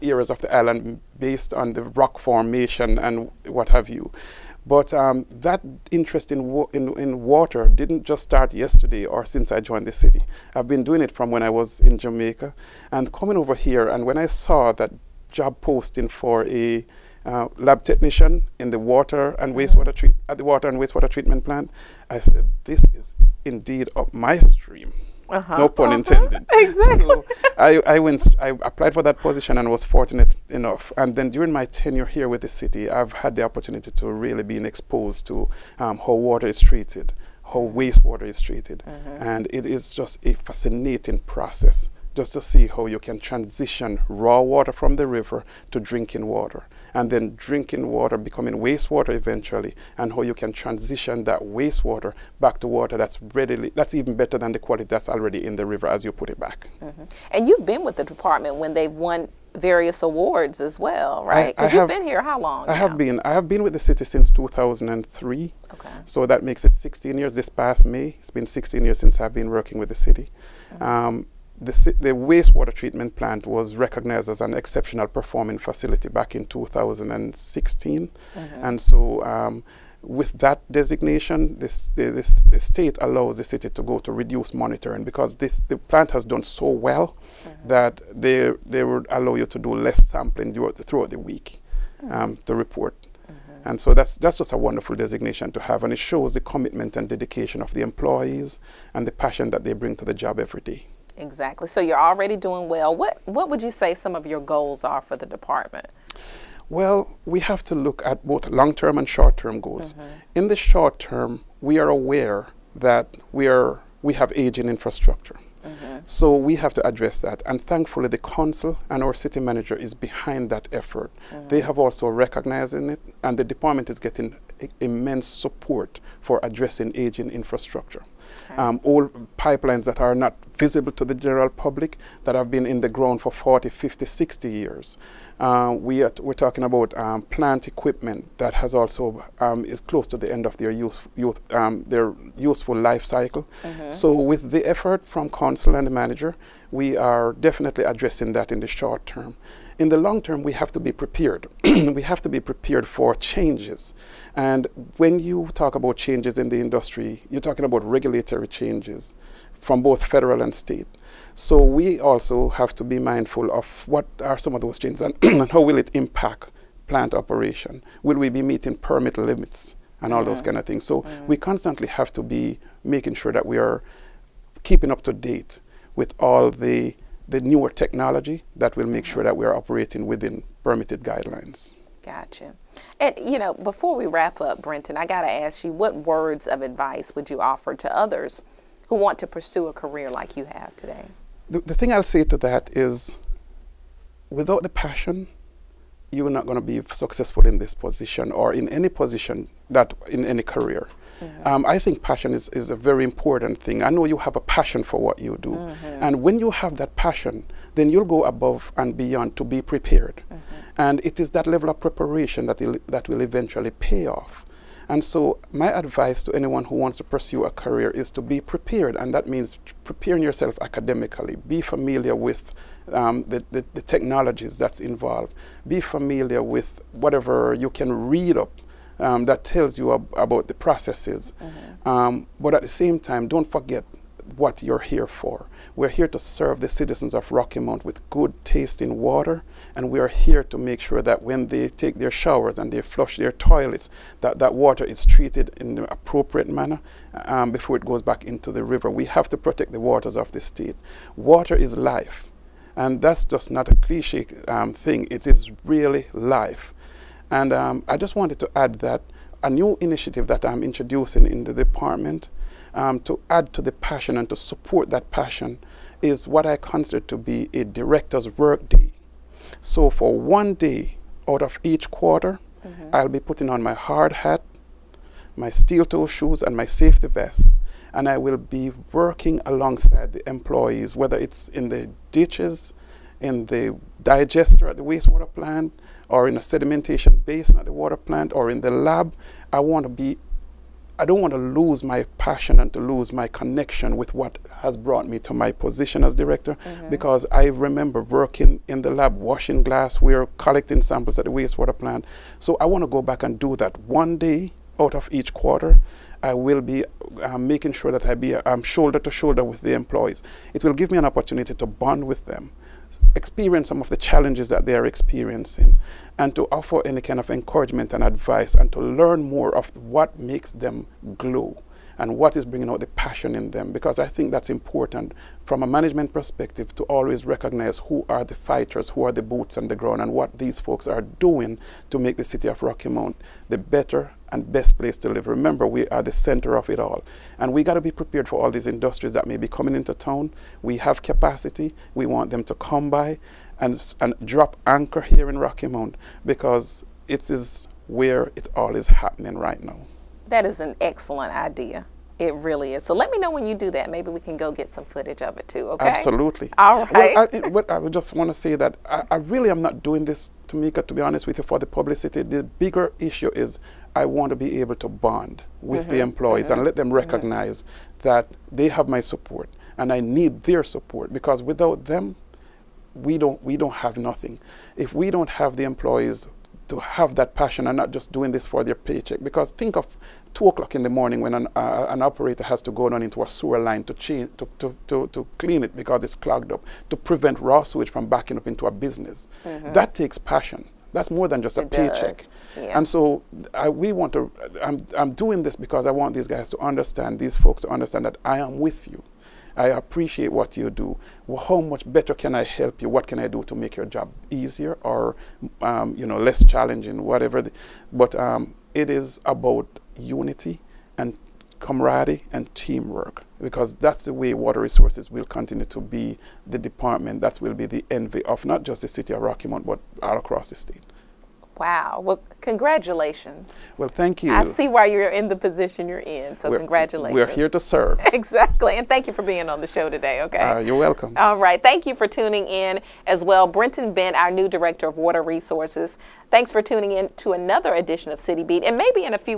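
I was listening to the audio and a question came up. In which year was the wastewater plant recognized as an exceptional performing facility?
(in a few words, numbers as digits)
2016.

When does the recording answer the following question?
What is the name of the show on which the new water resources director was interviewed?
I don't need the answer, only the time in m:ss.
7:18.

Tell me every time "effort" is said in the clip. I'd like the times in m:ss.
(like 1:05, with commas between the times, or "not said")
2:00, 2:24.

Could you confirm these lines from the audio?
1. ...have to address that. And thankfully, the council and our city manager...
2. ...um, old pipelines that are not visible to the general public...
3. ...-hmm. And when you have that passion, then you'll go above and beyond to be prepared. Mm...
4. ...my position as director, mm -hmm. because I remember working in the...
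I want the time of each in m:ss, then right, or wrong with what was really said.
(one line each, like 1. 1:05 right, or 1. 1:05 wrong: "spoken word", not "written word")
1. 1:56 right
2. 2:09 right
3. 3:25 right
4. 4:55 right.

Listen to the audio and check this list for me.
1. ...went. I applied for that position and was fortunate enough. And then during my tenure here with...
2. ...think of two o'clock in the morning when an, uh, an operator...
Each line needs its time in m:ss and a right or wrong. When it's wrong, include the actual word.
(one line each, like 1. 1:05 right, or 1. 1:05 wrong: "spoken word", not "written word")
1. 0:27 right
2. 6:19 right.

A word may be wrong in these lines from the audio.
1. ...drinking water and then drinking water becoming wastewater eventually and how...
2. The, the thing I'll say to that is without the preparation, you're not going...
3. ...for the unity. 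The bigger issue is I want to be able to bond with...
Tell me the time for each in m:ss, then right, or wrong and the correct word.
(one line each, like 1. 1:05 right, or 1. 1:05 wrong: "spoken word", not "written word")
1. 0:45 right
2. 3:11 wrong: "passion", not "preparation"
3. 6:01 wrong: "publicity", not "unity".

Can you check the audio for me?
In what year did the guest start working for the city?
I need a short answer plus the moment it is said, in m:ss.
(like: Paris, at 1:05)
2003, at 1:04.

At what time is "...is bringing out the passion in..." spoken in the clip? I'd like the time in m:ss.
5:22.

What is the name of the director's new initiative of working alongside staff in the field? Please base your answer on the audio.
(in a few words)
director's work day.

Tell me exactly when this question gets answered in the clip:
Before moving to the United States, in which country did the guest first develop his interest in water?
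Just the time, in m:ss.
0:11.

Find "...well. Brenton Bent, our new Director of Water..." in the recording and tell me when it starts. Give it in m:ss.
7:13.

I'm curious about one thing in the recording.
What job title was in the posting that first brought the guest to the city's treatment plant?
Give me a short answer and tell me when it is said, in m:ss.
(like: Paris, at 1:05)
lab technician, at 0:17.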